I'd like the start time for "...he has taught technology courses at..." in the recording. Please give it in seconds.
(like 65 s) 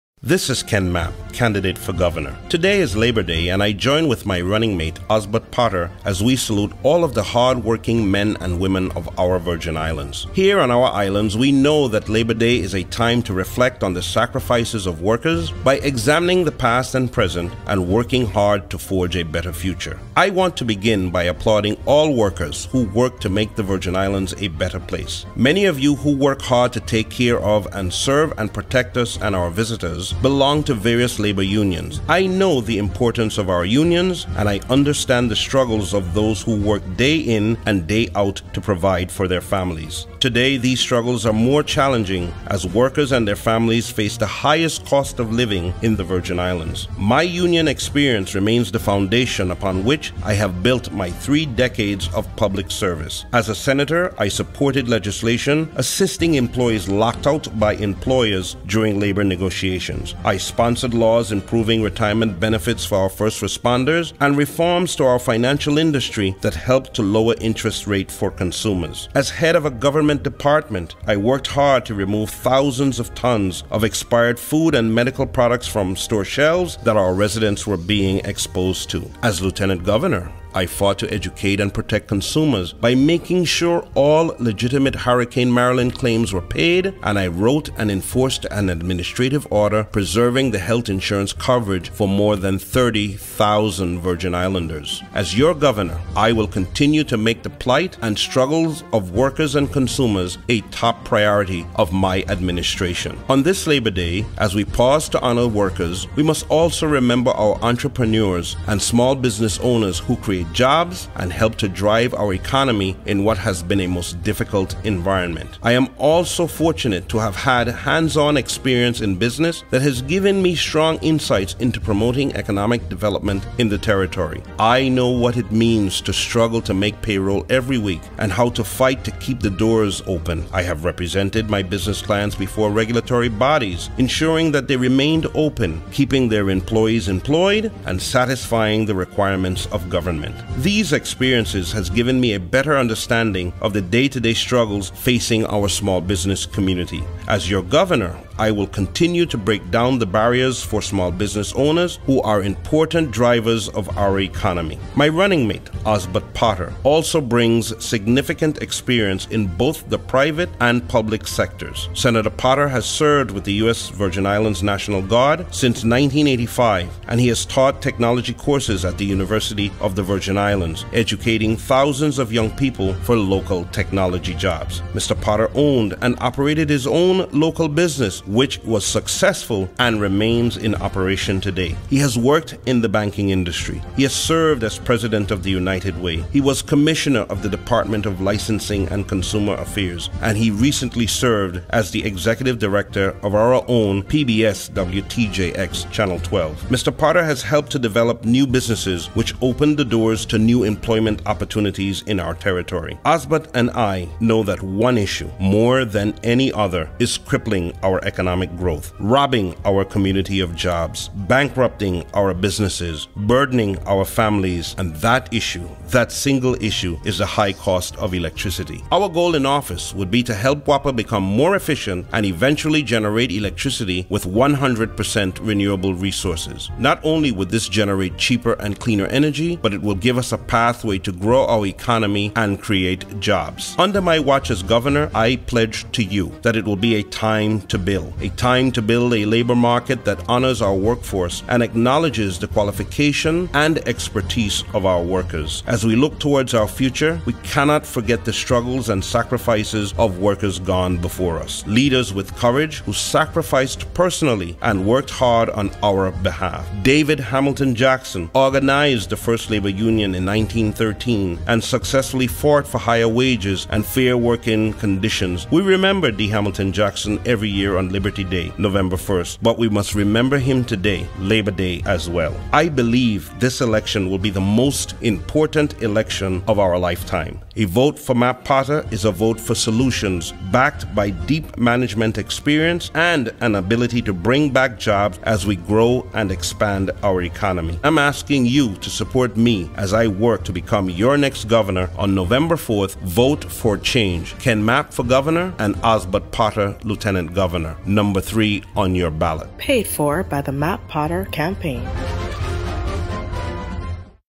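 167 s.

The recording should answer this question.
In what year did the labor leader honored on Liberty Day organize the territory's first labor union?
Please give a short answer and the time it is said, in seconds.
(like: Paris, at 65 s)
1913, at 260 s.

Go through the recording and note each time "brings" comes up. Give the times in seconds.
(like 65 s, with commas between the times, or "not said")
157 s, 284 s.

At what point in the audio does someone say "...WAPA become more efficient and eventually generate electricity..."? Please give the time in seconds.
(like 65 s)
220 s.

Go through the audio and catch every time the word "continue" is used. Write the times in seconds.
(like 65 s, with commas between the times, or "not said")
96 s, 148 s.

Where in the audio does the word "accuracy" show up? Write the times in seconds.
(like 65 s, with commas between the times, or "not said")
not said.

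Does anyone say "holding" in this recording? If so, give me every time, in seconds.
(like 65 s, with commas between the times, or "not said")
not said.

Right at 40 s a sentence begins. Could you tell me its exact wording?
Today, these struggles are more challenging as workers and their families face the highest cost of living in the Virgin Islands.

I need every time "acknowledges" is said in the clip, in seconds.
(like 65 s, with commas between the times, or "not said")
241 s.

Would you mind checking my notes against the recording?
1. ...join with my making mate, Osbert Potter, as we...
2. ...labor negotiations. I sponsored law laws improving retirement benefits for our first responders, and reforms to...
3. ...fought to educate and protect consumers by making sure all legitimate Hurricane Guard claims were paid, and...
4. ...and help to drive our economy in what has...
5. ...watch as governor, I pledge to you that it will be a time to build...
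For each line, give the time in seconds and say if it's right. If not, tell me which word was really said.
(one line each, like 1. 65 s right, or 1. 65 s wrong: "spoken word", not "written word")
1. 3 s wrong: "running", not "making"
2. 58 s right
3. 80 s wrong: "Marilyn", not "Guard"
4. 111 s right
5. 234 s right.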